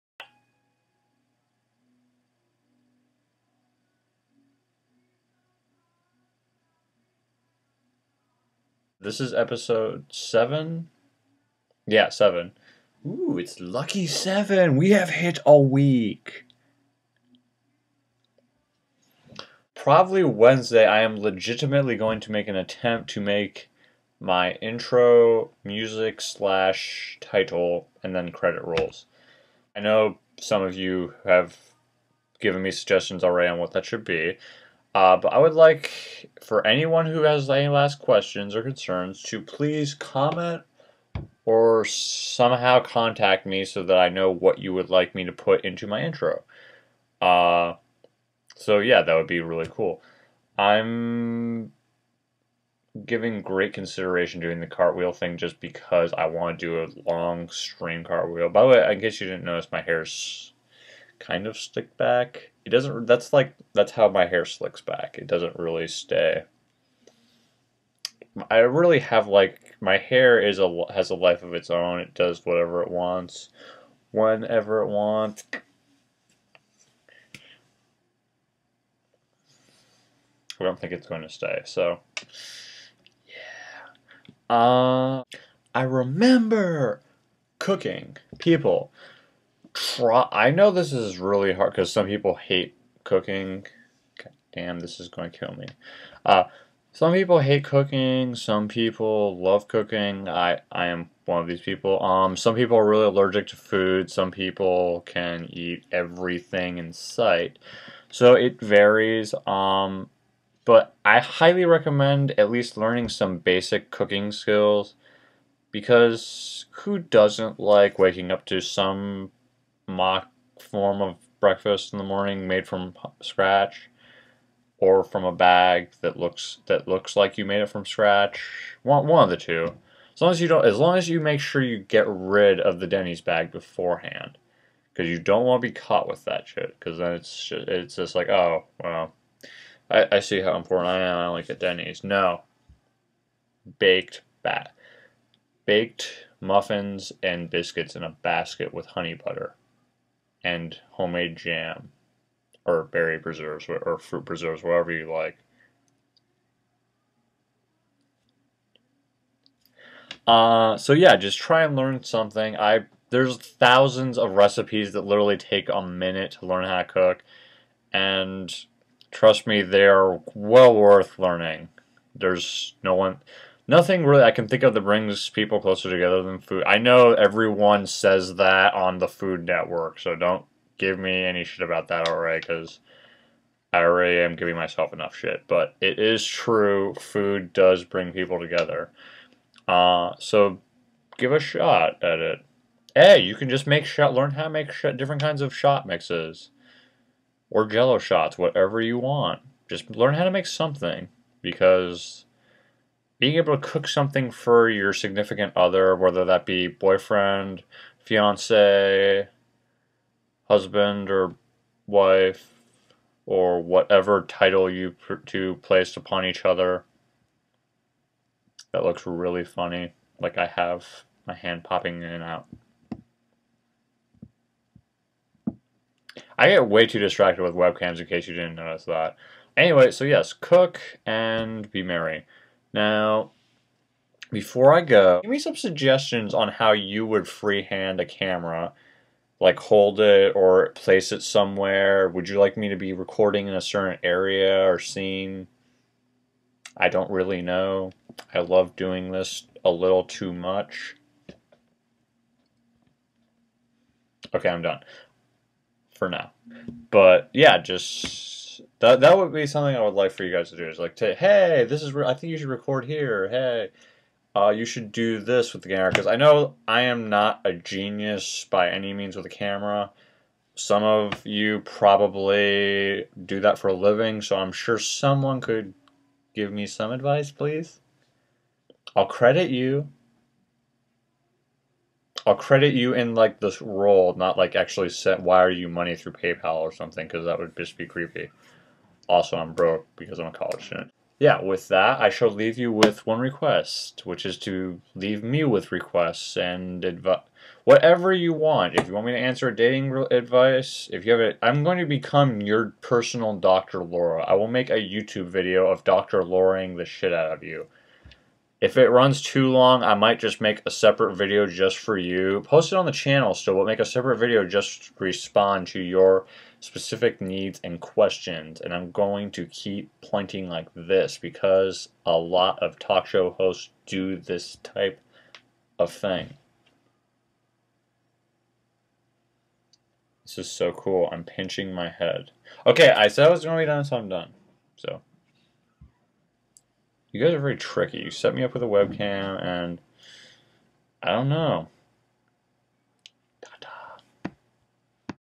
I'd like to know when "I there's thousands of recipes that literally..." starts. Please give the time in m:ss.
2:42.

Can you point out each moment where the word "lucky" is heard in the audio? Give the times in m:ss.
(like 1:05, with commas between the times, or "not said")
0:13.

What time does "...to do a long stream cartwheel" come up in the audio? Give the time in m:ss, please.
0:56.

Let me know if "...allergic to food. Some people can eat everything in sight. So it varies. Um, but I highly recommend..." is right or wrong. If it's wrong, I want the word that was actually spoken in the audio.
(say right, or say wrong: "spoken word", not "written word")
right.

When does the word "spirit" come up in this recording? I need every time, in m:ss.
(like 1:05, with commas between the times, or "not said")
not said.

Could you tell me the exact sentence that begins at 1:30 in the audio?
I know this is really hard because some people hate cooking.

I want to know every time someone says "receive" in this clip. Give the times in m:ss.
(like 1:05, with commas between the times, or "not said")
not said.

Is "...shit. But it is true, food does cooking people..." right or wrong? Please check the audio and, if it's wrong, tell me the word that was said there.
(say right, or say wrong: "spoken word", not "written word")
wrong: "bring", not "cooking".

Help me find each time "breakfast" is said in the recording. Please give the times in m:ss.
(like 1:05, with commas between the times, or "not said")
2:01.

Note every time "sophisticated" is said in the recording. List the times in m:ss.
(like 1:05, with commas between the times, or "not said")
not said.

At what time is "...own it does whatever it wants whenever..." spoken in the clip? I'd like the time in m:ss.
1:11.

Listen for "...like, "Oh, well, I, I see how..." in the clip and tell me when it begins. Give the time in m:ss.
2:18.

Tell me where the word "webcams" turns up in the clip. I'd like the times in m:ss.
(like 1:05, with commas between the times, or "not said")
3:47, 5:38.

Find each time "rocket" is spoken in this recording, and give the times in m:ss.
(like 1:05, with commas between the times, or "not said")
not said.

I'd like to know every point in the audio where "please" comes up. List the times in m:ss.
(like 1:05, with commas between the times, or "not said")
0:39, 4:37.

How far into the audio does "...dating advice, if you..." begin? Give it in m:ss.
4:59.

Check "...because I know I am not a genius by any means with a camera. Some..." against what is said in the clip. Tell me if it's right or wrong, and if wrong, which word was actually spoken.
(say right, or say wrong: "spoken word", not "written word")
right.